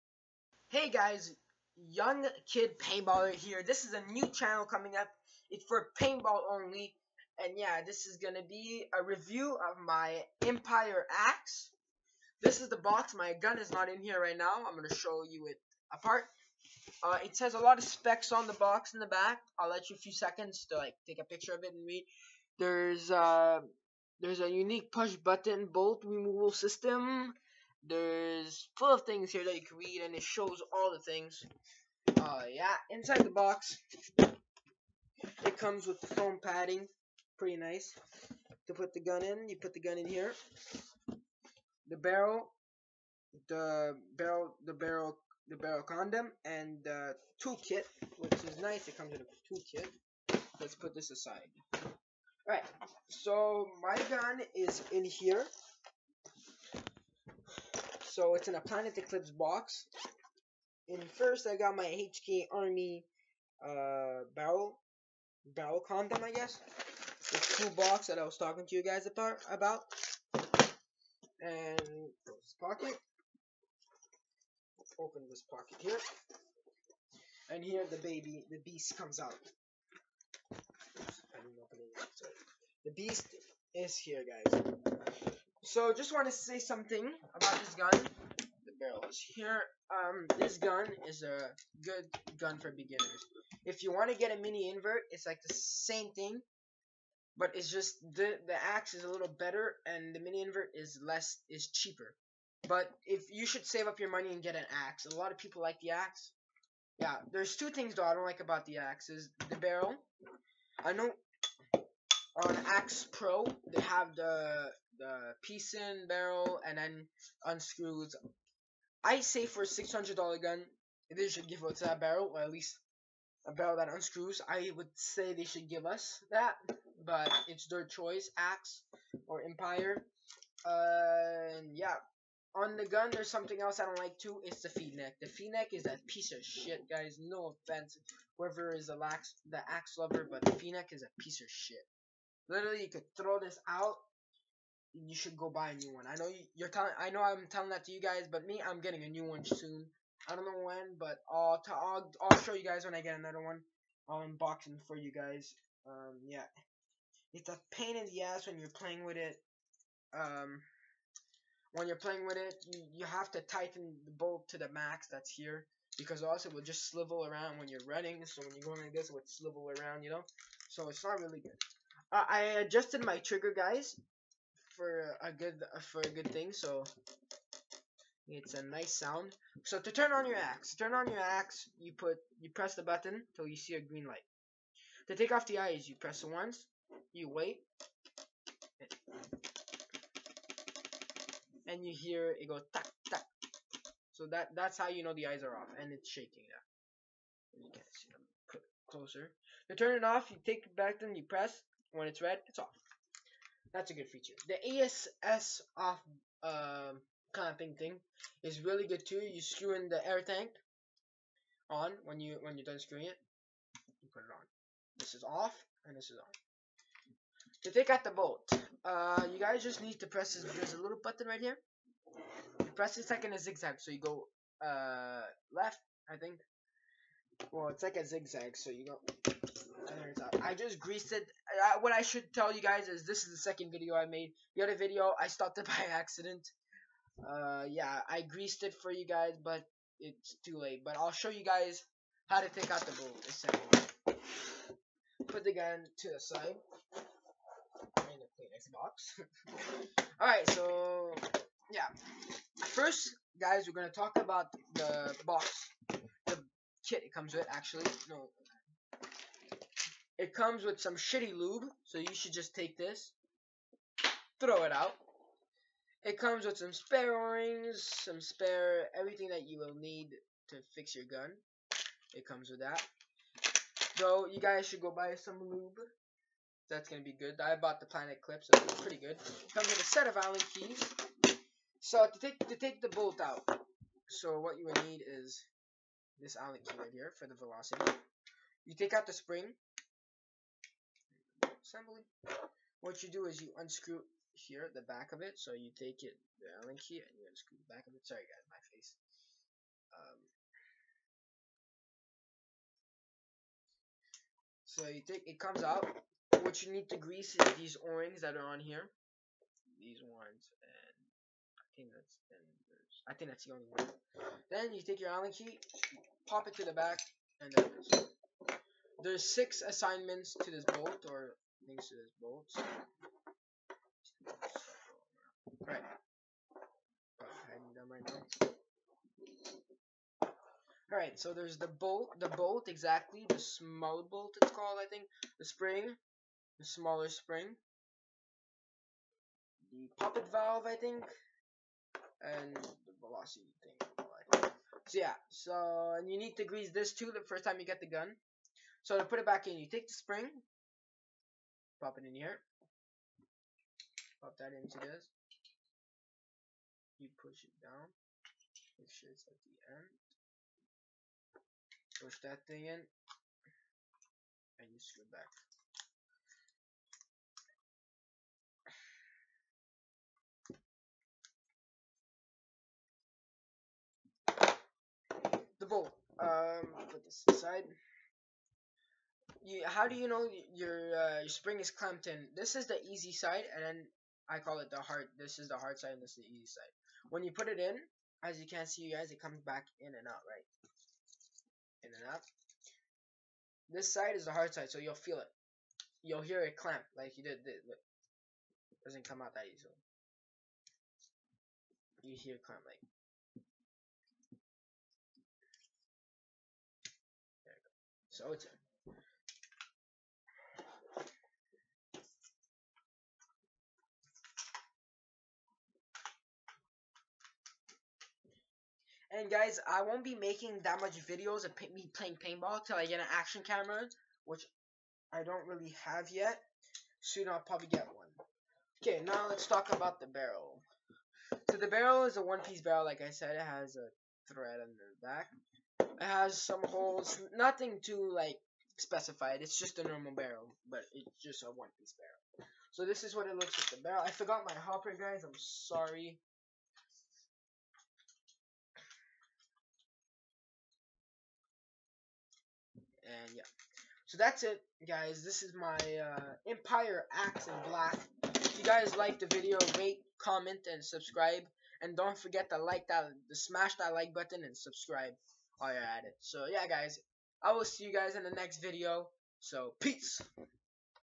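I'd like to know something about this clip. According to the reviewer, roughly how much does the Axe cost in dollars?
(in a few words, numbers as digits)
$600.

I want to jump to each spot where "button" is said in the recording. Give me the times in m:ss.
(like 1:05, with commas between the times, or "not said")
0:25, 3:02, 3:41, 7:44.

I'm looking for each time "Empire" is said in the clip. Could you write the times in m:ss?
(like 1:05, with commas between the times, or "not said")
0:10, 2:09, 7:36.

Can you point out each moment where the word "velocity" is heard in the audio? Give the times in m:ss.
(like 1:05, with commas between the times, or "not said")
4:47, 5:43.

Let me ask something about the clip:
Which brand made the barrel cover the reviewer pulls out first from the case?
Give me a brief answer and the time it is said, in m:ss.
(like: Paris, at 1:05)
HK Army, at 1:01.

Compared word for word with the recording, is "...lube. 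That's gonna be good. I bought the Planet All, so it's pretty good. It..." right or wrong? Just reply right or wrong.
wrong.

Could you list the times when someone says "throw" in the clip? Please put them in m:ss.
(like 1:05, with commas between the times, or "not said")
2:23, 4:24.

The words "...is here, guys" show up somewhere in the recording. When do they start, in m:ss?
1:23.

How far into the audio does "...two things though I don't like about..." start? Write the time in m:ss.
1:47.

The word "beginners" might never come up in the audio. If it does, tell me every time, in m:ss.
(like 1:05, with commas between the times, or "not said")
1:32.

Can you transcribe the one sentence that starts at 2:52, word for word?
Uh, I adjusted my trigger, guys for a good for a good thing.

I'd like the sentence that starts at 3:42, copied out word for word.
You press it like in a zigzag, so you go uh, left, I think, well, it's like a zigzag, so you go.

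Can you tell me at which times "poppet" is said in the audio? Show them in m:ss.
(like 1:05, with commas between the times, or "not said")
5:39.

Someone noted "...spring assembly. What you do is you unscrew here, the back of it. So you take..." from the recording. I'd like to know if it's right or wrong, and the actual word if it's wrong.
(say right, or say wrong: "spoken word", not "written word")
right.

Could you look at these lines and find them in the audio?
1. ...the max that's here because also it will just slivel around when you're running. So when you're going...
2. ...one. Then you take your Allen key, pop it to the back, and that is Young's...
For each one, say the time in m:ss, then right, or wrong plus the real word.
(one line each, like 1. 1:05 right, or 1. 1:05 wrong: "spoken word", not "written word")
1. 2:44 right
2. 5:13 wrong: "There", not "Young".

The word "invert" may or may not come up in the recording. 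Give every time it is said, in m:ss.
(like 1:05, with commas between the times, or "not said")
1:34, 1:40.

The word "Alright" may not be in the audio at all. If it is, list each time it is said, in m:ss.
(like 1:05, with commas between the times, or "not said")
0:52, 5:30.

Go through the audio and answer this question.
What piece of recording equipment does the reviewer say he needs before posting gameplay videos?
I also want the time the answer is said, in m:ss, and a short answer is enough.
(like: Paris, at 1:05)
Action camera, at 7:03.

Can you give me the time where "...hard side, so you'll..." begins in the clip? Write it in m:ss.
6:34.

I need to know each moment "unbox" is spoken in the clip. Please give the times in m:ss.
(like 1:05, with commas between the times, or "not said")
2:34.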